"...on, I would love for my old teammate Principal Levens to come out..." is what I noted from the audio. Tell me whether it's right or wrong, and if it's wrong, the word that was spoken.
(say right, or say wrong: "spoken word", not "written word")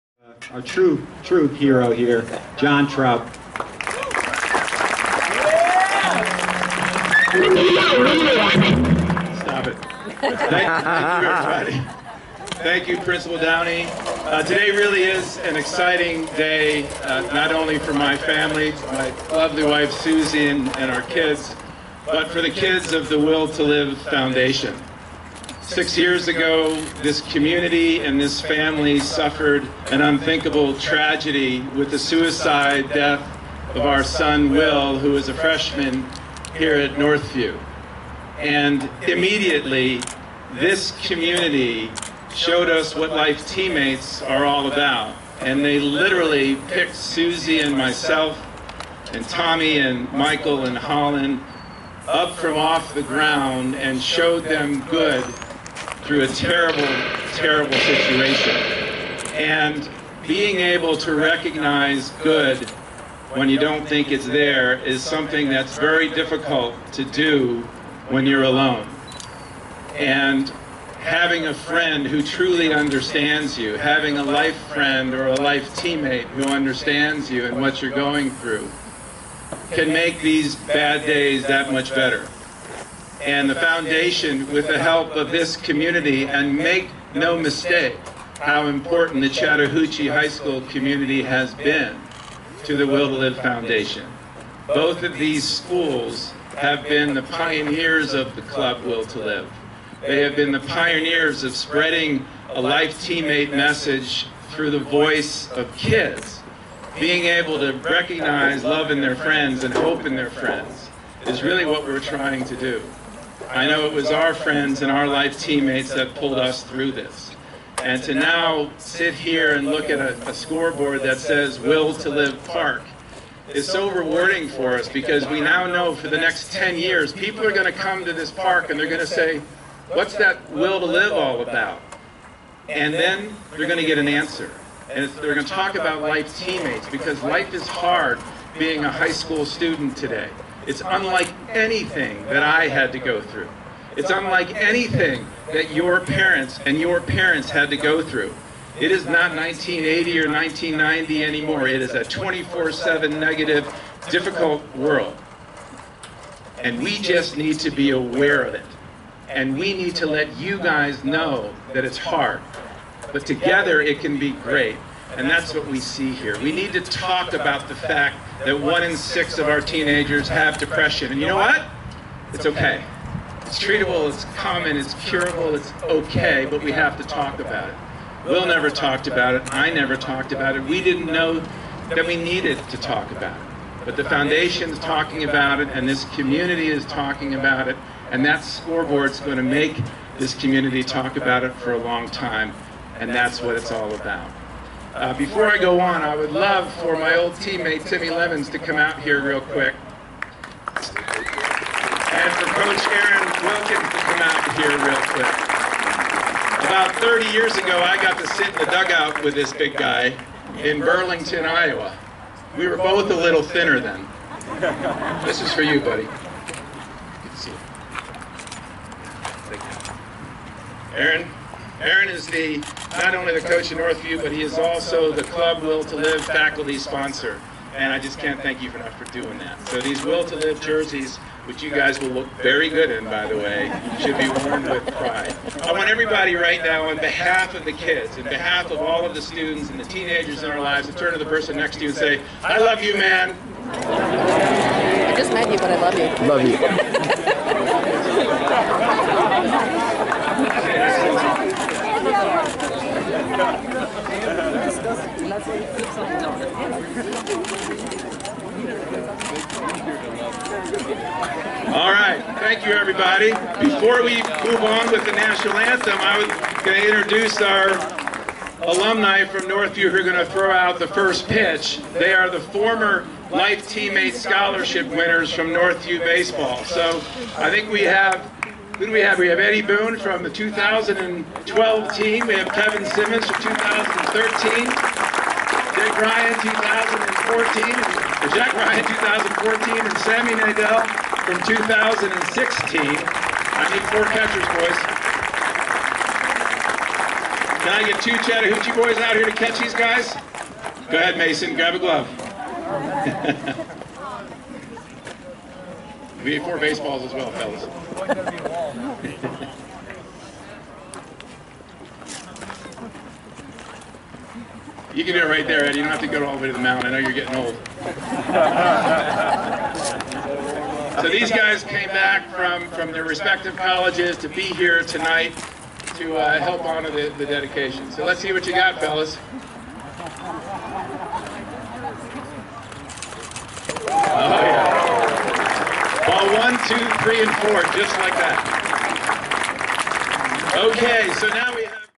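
wrong: "Timmy", not "Principal".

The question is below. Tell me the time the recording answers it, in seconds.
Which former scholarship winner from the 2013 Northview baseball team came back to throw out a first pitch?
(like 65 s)
282 s.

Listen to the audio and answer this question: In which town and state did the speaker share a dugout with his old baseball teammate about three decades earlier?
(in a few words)
Burlington, Iowa.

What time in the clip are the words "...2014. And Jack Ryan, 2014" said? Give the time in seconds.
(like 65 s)
286 s.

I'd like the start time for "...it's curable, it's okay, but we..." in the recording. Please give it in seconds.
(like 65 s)
174 s.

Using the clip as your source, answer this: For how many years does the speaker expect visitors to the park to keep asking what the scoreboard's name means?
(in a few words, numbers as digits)
10.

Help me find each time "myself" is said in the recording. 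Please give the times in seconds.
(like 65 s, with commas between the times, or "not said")
47 s.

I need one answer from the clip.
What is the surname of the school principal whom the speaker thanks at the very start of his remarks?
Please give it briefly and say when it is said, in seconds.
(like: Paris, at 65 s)
Downey, at 13 s.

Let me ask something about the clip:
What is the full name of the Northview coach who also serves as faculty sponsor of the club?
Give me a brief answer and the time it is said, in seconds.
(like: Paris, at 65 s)
Aaron Wilkins, at 202 s.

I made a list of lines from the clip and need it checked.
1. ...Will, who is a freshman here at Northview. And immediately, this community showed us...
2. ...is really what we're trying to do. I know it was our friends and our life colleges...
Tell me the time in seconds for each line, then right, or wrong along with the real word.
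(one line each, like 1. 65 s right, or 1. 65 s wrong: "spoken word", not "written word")
1. 34 s right
2. 111 s wrong: "teammates", not "colleges".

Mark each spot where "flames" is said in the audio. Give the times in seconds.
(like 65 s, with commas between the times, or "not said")
not said.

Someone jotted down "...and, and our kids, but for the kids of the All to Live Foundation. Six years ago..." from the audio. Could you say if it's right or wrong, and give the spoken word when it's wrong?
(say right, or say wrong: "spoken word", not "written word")
wrong: "Will", not "All".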